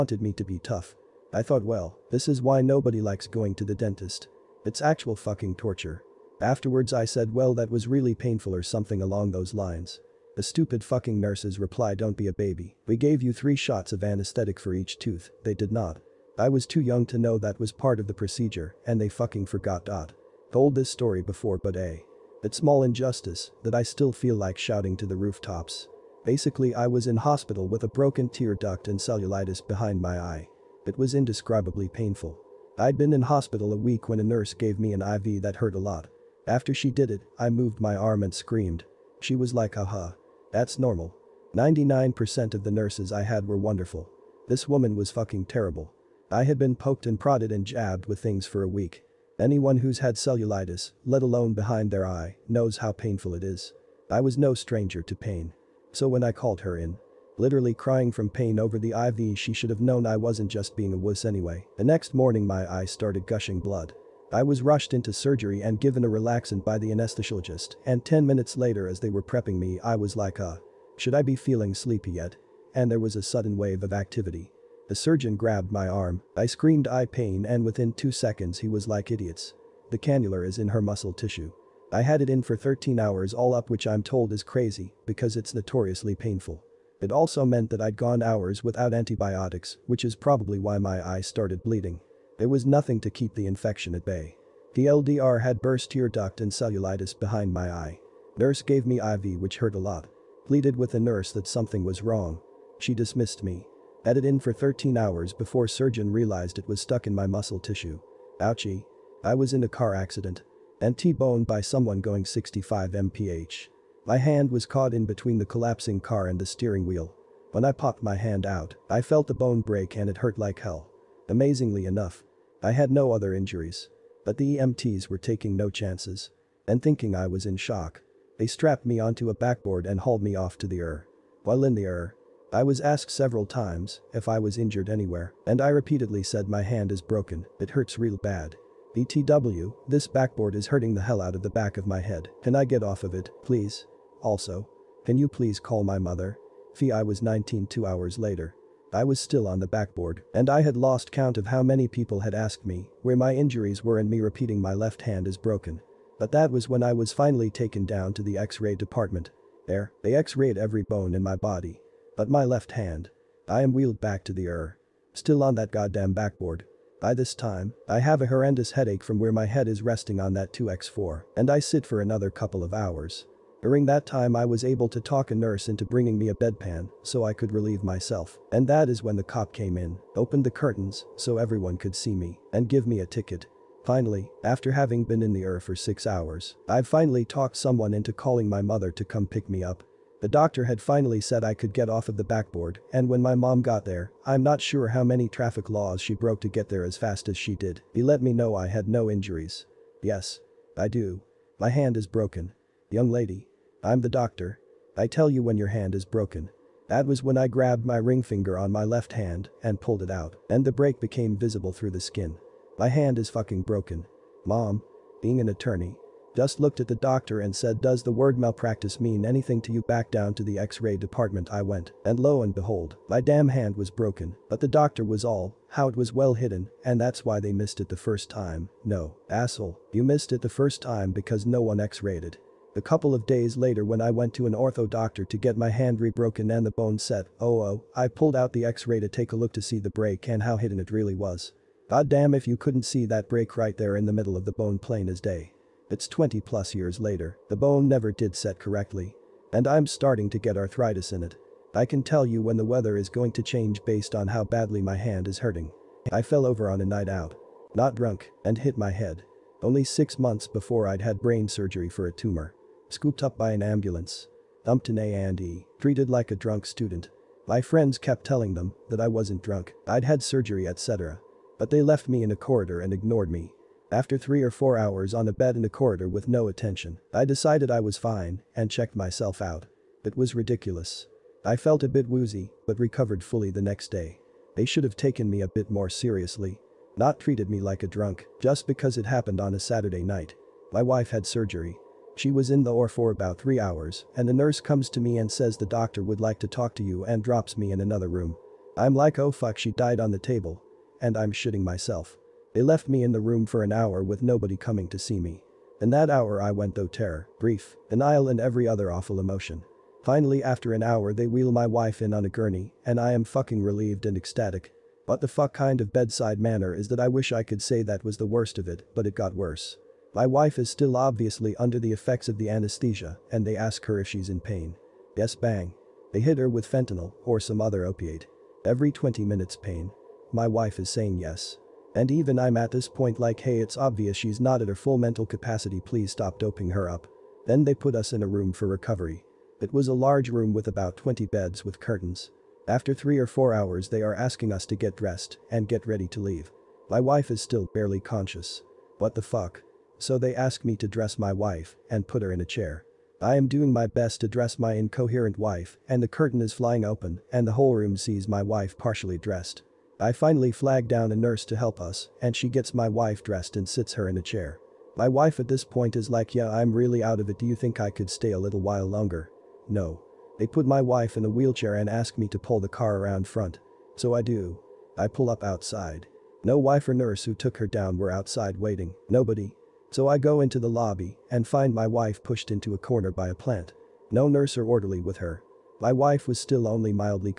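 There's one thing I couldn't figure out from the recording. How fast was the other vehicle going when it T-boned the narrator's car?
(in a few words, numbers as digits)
65 mph.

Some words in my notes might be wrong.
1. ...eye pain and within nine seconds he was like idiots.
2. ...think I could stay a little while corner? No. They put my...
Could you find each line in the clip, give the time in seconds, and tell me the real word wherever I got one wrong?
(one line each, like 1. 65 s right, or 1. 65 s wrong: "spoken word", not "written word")
1. 76 s wrong: "two", not "nine"
2. 367 s wrong: "longer", not "corner".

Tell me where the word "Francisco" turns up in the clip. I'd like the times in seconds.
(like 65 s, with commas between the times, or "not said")
not said.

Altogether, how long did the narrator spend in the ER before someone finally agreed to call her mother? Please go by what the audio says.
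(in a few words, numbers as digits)
6 hours.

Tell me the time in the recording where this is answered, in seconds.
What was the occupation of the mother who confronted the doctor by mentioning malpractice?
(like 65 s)
215 s.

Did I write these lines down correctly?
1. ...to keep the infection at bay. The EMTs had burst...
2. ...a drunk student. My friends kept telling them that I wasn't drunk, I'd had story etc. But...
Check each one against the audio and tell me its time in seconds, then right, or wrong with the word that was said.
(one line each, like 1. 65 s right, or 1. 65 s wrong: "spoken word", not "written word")
1. 93 s wrong: "LDR", not "EMTs"
2. 266 s wrong: "surgery", not "story".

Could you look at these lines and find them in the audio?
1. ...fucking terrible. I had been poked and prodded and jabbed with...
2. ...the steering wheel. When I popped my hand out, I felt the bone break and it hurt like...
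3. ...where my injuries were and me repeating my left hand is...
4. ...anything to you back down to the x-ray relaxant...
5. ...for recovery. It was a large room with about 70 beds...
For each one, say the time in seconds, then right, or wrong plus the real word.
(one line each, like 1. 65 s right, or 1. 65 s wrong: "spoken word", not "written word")
1. 45 s right
2. 116 s right
3. 153 s right
4. 219 s wrong: "department", not "relaxant"
5. 338 s wrong: "20", not "70".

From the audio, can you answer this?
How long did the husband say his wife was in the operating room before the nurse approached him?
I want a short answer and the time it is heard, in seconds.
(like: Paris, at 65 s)
About three hours, at 293 s.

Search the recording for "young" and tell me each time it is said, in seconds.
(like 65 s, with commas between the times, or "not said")
16 s, 202 s.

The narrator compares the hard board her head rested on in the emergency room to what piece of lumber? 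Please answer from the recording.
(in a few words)
2x4.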